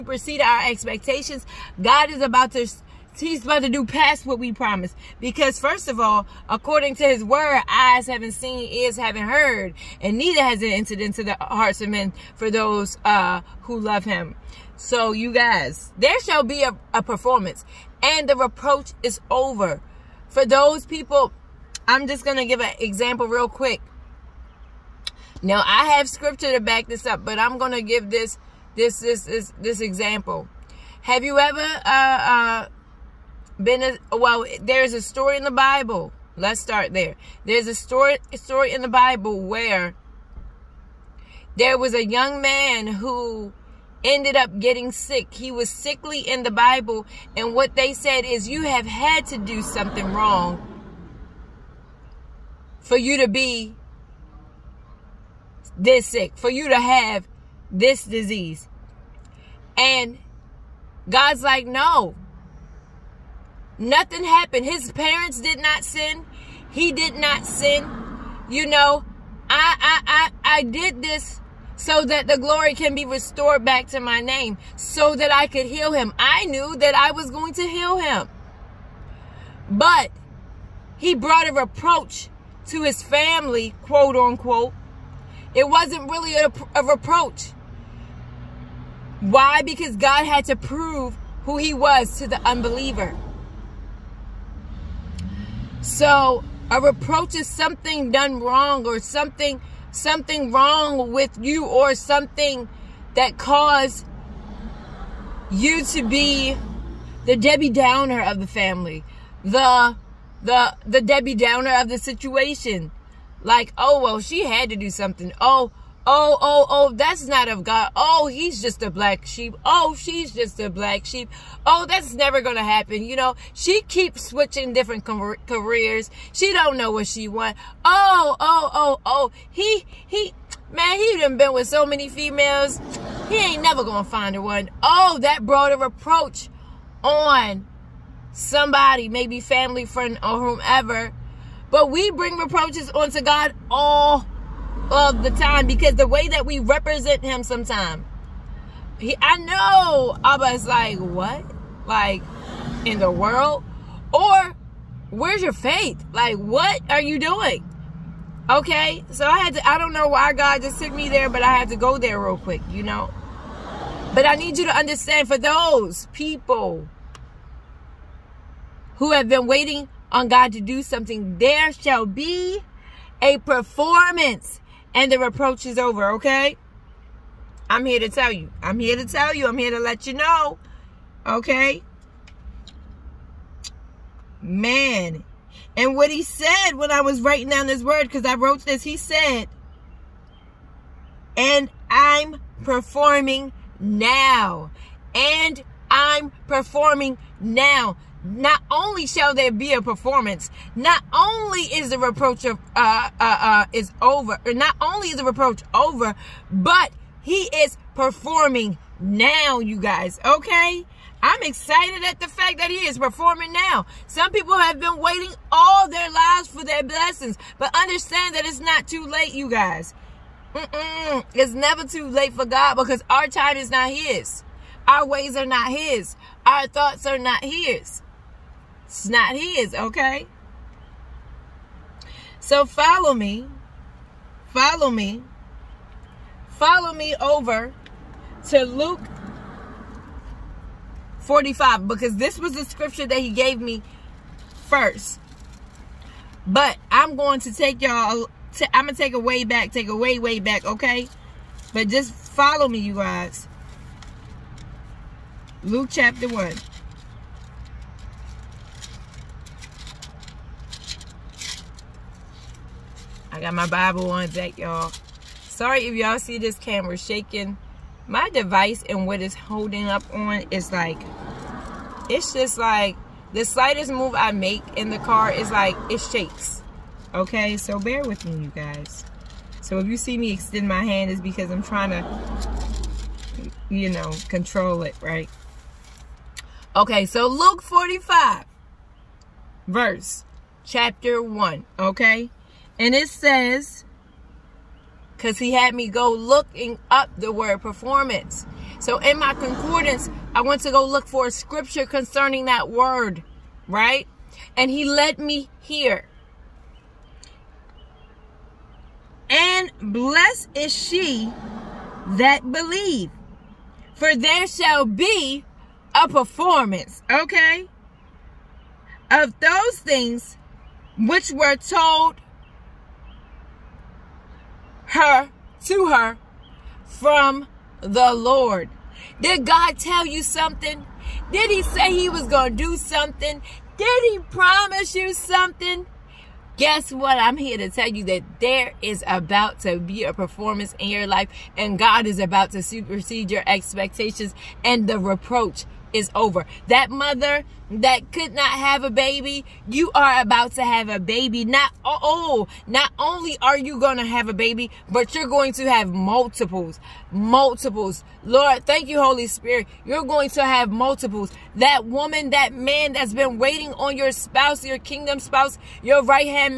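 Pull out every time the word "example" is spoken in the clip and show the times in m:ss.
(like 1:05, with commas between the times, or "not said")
0:22, 0:29.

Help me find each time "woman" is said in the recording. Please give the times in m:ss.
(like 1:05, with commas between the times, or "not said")
6:01.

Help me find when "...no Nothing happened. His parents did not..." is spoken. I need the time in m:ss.
1:01.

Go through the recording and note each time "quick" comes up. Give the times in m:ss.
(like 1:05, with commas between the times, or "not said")
0:23, 2:42.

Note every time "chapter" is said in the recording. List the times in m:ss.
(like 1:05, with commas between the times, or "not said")
4:15, 4:50.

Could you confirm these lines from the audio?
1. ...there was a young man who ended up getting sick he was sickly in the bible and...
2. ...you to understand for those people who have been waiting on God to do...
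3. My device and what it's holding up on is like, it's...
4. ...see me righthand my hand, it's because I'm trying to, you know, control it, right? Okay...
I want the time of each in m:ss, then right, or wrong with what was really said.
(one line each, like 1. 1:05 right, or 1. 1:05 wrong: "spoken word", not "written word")
1. 0:41 right
2. 2:44 right
3. 4:28 right
4. 4:39 wrong: "extend", not "righthand".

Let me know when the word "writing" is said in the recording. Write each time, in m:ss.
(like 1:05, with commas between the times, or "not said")
3:07.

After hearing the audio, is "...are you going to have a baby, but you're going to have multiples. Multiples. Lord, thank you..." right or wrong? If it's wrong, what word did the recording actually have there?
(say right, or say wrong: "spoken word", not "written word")
right.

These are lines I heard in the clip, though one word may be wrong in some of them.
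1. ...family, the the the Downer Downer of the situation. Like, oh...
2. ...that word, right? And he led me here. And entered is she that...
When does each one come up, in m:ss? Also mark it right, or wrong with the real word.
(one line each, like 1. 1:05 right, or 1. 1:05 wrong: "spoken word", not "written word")
1. 1:48 wrong: "Debbie", not "Downer"
2. 5:02 wrong: "blessed", not "entered".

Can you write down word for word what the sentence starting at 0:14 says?
So you guys, there shall be a, a performance and the reproach is over.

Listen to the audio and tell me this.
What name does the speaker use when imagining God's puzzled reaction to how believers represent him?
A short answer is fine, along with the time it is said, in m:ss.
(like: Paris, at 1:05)
Abba, at 2:30.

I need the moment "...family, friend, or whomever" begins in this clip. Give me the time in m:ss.
2:19.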